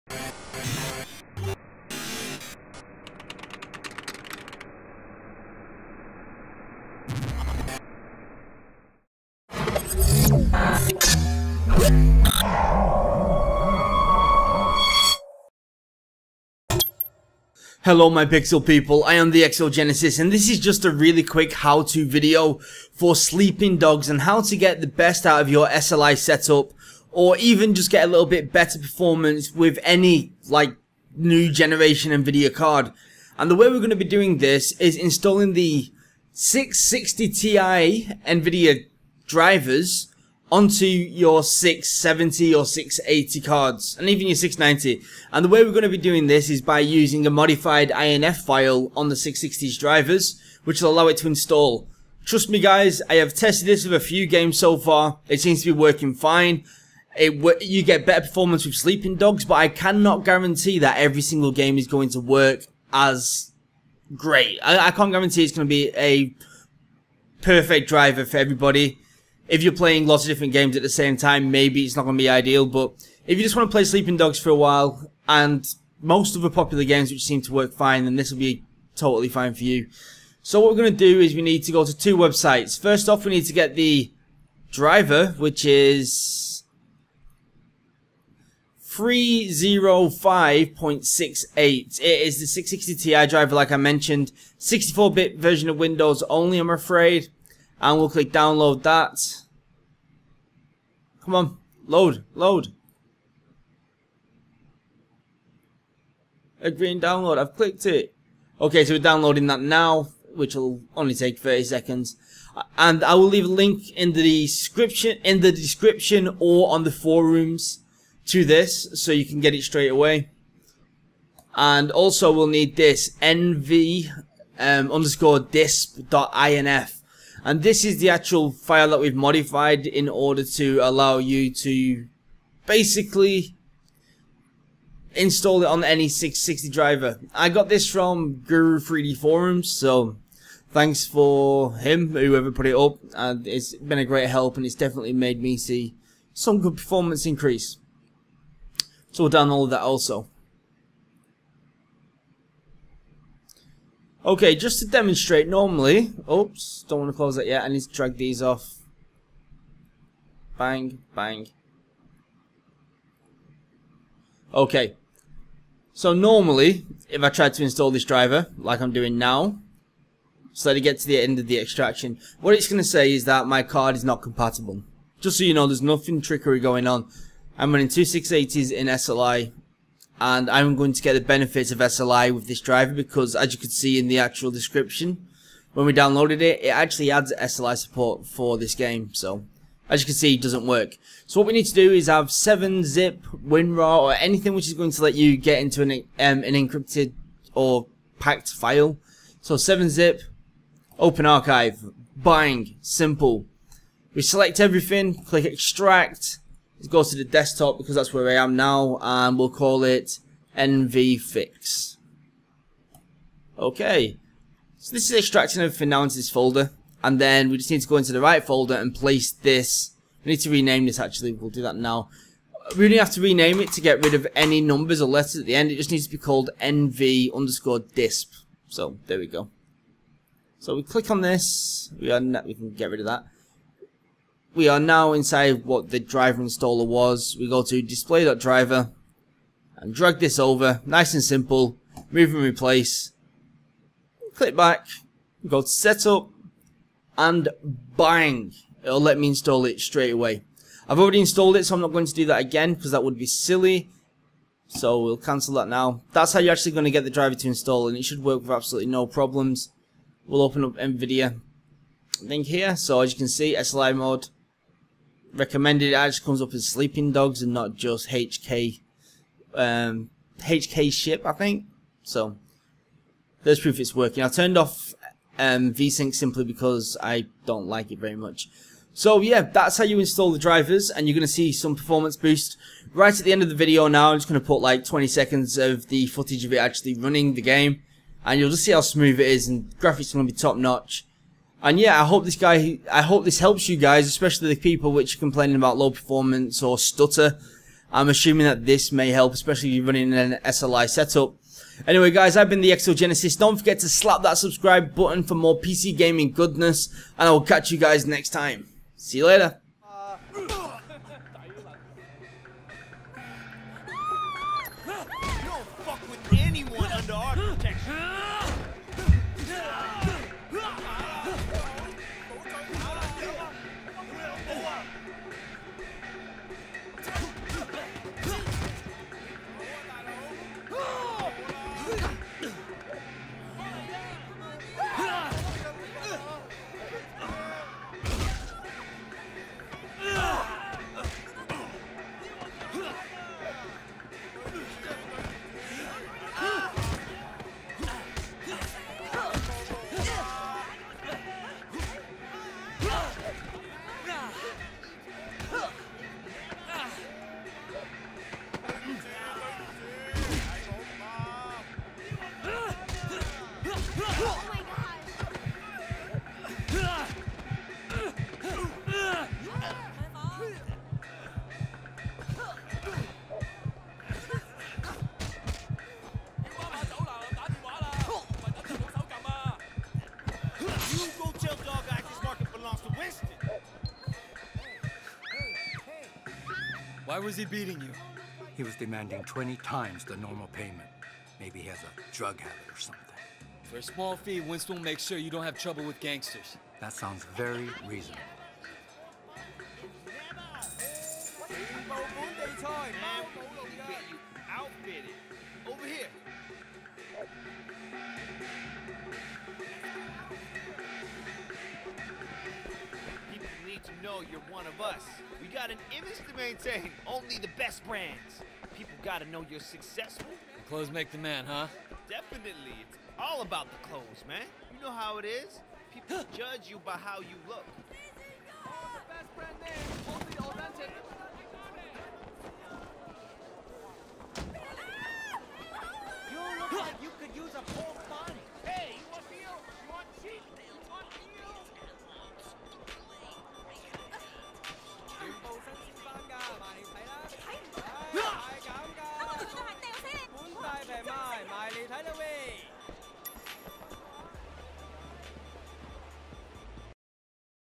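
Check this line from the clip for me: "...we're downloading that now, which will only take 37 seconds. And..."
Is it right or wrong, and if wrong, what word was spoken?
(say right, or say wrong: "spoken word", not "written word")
wrong: "30", not "37".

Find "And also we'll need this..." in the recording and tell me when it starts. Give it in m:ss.
2:01.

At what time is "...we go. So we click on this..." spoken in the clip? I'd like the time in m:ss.
3:49.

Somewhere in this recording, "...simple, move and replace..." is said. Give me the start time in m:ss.
4:01.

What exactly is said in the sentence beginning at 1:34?
64-bit version of Windows only, I'm afraid and we'll click download that.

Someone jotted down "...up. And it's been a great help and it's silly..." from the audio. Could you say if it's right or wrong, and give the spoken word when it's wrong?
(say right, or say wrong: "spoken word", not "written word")
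wrong: "definitely", not "silly".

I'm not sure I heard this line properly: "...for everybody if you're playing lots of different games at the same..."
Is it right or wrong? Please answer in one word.
right.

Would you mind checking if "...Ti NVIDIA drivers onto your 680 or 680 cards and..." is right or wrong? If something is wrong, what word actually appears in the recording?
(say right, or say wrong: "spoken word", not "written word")
wrong: "670", not "680".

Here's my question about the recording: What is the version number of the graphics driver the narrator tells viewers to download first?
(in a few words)
305.68.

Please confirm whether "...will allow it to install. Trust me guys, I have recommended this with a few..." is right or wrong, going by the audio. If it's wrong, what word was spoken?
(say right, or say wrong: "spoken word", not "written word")
wrong: "tested", not "recommended".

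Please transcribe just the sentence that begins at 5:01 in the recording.
Anyway guys, I've been the Exogenesis.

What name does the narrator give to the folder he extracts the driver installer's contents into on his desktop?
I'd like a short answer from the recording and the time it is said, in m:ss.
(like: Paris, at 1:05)
nvfix, at 3:30.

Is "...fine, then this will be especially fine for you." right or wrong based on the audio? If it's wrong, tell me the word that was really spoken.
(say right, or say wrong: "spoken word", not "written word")
wrong: "totally", not "especially".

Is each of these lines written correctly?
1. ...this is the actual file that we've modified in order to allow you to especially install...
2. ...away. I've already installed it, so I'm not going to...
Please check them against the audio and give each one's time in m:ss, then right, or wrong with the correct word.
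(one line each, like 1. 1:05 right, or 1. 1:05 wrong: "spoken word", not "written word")
1. 2:07 wrong: "basically", not "especially"
2. 4:10 right.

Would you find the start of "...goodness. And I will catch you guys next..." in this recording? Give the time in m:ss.
5:06.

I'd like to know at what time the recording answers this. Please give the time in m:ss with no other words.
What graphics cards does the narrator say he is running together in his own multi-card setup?
2:57.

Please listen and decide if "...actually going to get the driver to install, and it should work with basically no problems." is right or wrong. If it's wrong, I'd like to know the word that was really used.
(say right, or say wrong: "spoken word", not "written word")
wrong: "absolutely", not "basically".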